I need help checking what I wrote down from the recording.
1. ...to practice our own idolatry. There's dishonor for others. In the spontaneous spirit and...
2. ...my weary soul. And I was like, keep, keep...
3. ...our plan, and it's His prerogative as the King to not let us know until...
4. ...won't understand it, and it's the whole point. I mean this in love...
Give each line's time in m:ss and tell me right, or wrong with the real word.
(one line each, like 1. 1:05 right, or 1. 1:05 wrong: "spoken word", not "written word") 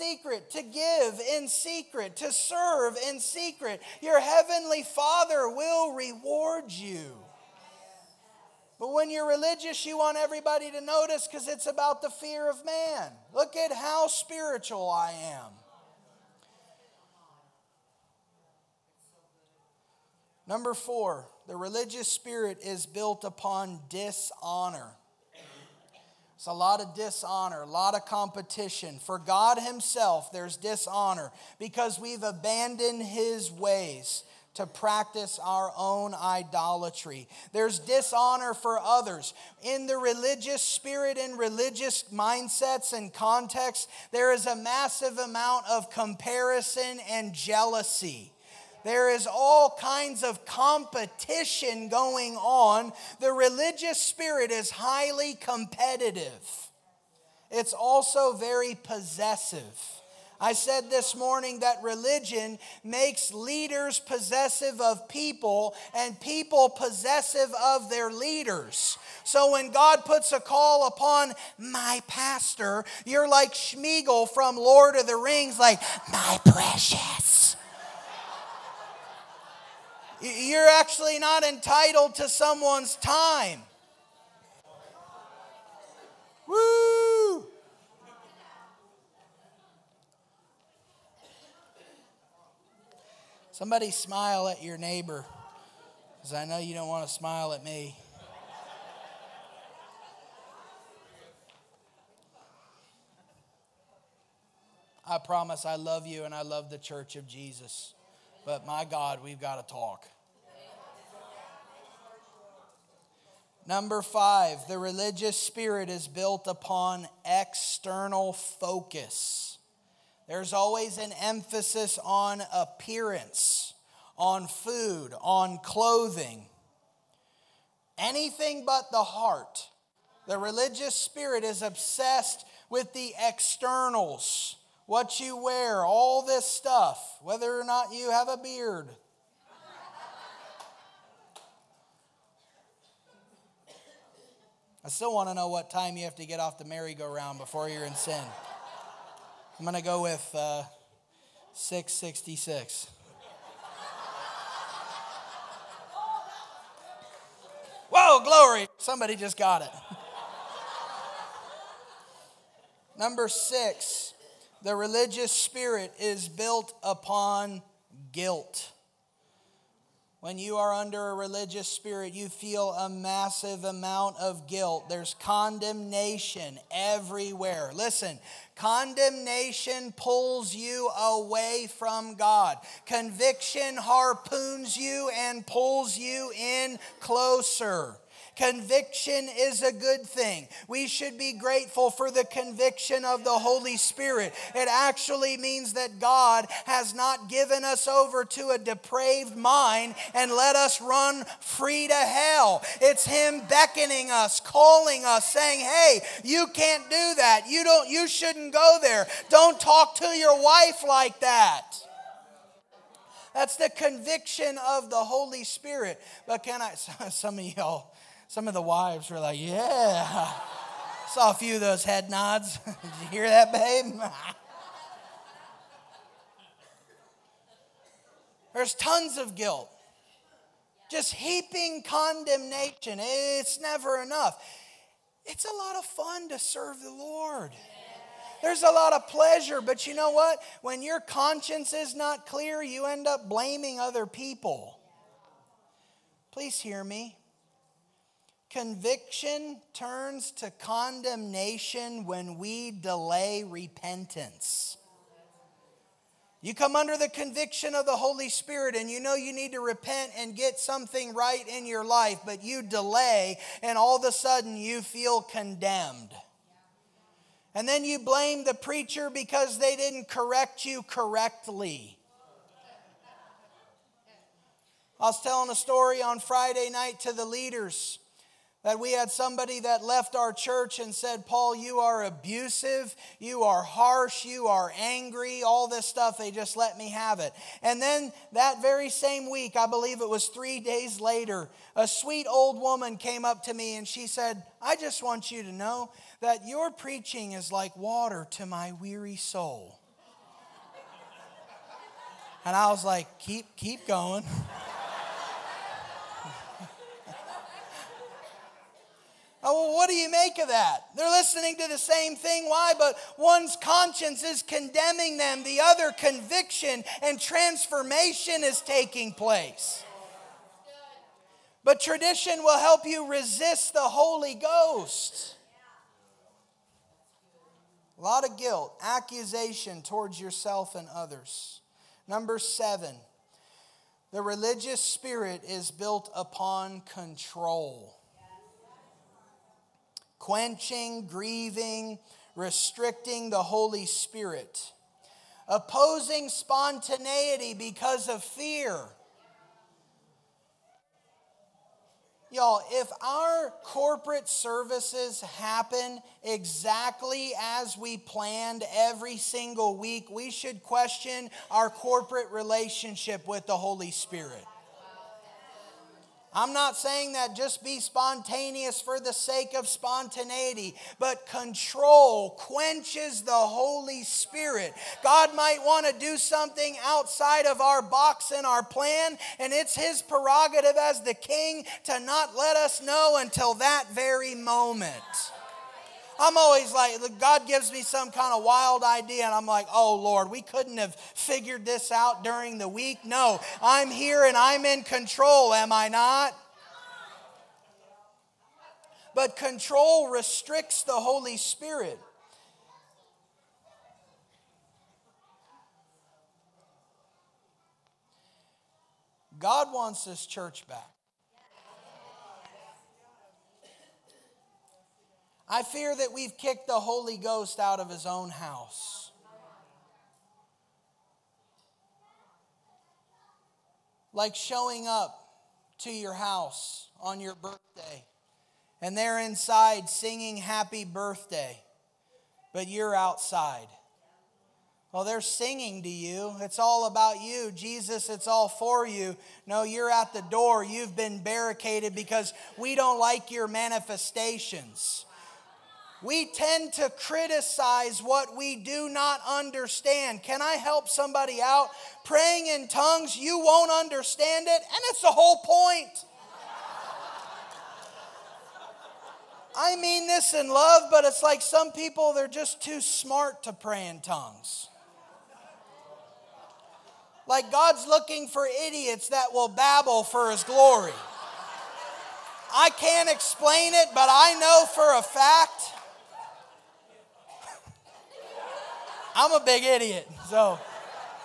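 1. 0:34 wrong: "religious", not "spontaneous"
2. 4:58 right
3. 6:18 right
4. 7:33 right.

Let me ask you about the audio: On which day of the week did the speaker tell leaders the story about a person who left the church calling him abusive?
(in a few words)
Friday.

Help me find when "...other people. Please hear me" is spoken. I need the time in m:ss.
4:03.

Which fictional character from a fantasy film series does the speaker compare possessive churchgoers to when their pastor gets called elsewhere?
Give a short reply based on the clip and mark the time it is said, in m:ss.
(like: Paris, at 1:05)
Sméagol, at 1:13.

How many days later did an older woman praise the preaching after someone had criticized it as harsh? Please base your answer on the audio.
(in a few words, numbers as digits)
3.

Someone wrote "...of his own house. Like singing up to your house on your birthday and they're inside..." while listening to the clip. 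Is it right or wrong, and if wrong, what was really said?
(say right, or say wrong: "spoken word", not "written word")
wrong: "showing", not "singing".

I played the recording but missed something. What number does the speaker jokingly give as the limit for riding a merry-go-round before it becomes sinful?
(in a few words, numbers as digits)
666.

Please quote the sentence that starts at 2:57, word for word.
Listen, condemnation pulls you away from God, conviction harpoons you and pulls you in closer.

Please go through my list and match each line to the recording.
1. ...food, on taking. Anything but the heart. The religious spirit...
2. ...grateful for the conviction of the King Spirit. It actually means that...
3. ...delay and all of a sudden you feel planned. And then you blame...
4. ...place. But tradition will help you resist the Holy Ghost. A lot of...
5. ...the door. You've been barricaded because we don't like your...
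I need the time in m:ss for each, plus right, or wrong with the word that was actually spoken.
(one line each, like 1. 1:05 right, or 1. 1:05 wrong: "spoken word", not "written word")
1. 2:04 wrong: "clothing", not "taking"
2. 3:11 wrong: "Holy", not "King"
3. 4:22 wrong: "condemned", not "planned"
4. 5:19 right
5. 7:20 right.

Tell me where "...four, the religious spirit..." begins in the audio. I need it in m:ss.
0:20.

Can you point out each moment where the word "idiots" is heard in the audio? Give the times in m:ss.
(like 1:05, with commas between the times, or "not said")
7:48, 7:59.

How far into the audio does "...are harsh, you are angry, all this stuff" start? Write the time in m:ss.
4:43.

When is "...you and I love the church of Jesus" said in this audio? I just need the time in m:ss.
1:46.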